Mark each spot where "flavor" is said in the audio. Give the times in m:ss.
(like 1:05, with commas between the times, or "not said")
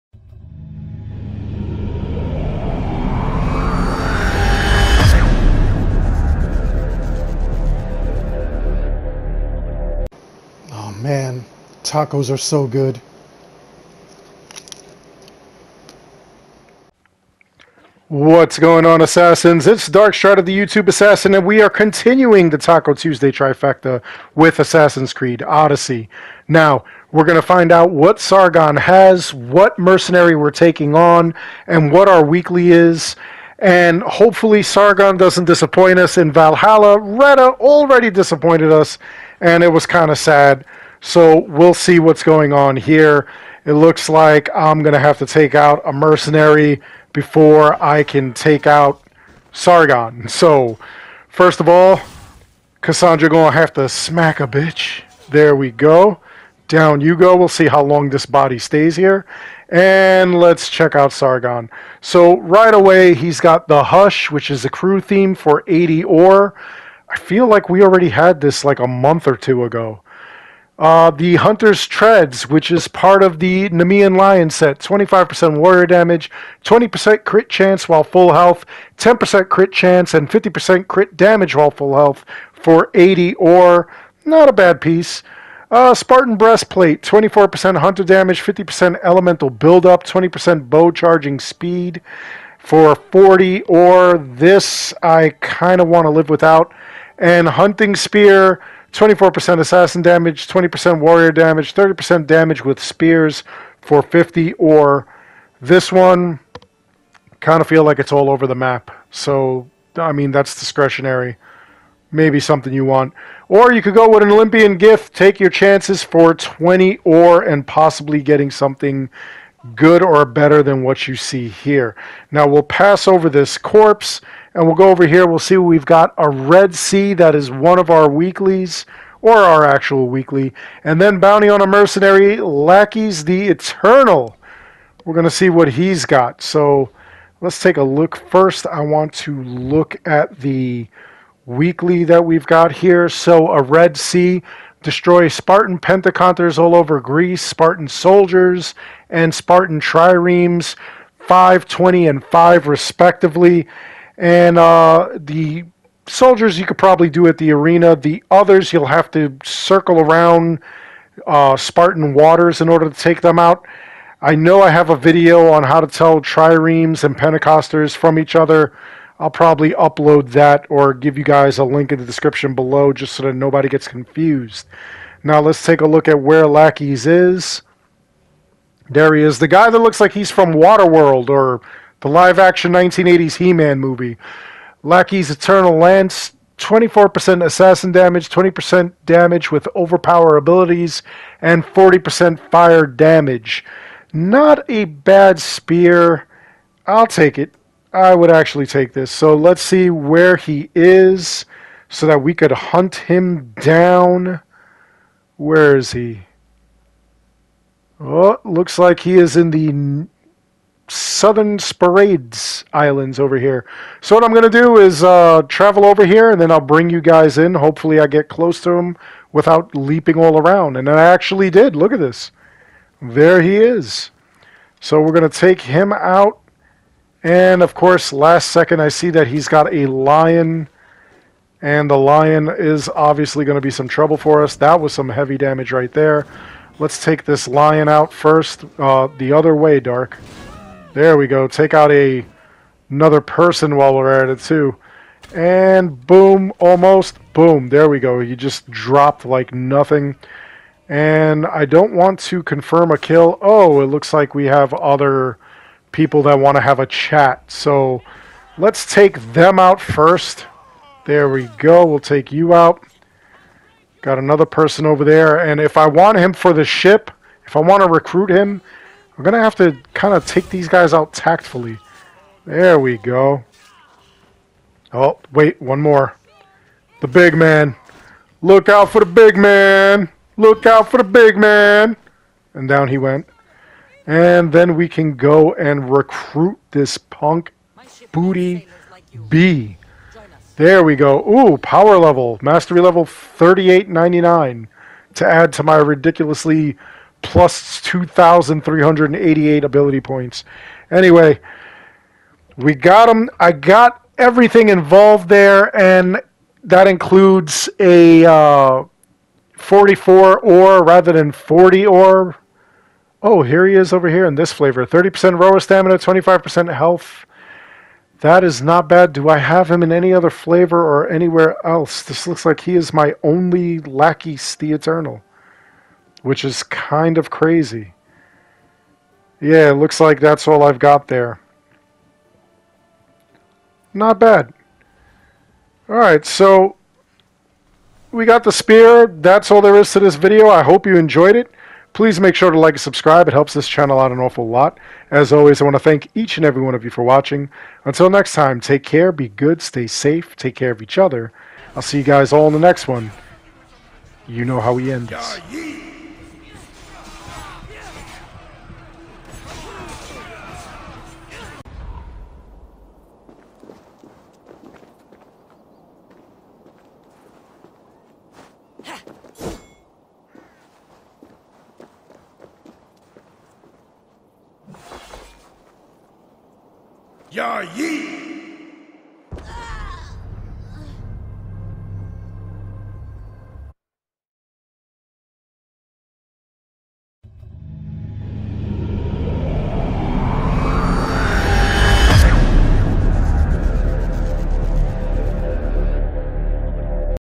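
5:14, 5:20.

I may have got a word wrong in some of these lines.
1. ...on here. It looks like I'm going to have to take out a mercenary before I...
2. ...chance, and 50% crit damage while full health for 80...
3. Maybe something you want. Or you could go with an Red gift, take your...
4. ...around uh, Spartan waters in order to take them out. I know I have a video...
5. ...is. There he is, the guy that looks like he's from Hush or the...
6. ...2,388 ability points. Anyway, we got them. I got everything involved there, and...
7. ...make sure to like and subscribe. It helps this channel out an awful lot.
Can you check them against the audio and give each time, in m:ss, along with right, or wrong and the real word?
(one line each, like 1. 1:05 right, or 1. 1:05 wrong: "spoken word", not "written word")
1. 0:42 right
2. 1:19 right
3. 1:52 wrong: "Olympian", not "Red"
4. 2:39 right
5. 2:57 wrong: "Waterworld", not "Hush"
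6. 4:57 right
7. 5:42 right.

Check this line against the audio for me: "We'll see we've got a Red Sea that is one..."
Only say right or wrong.
right.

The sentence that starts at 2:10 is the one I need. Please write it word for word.
And then Bounty on a Mercenary, Lackeys the Eternal.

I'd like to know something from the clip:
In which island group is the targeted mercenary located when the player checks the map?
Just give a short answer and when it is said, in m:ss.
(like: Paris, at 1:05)
Southern Sporades Islands, at 3:30.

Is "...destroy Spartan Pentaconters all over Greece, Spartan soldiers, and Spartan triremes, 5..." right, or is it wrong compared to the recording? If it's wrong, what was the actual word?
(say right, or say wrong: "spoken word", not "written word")
right.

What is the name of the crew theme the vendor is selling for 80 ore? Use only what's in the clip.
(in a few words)
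The Hush.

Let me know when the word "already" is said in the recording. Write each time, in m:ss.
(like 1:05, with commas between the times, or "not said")
0:37, 1:07.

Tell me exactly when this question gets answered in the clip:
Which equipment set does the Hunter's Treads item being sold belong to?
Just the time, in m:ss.
1:13.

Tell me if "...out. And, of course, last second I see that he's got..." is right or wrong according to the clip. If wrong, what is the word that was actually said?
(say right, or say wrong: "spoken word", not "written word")
right.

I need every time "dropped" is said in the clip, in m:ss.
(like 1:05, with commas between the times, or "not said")
4:08.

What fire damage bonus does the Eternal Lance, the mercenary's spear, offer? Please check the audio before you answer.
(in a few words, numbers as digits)
40%.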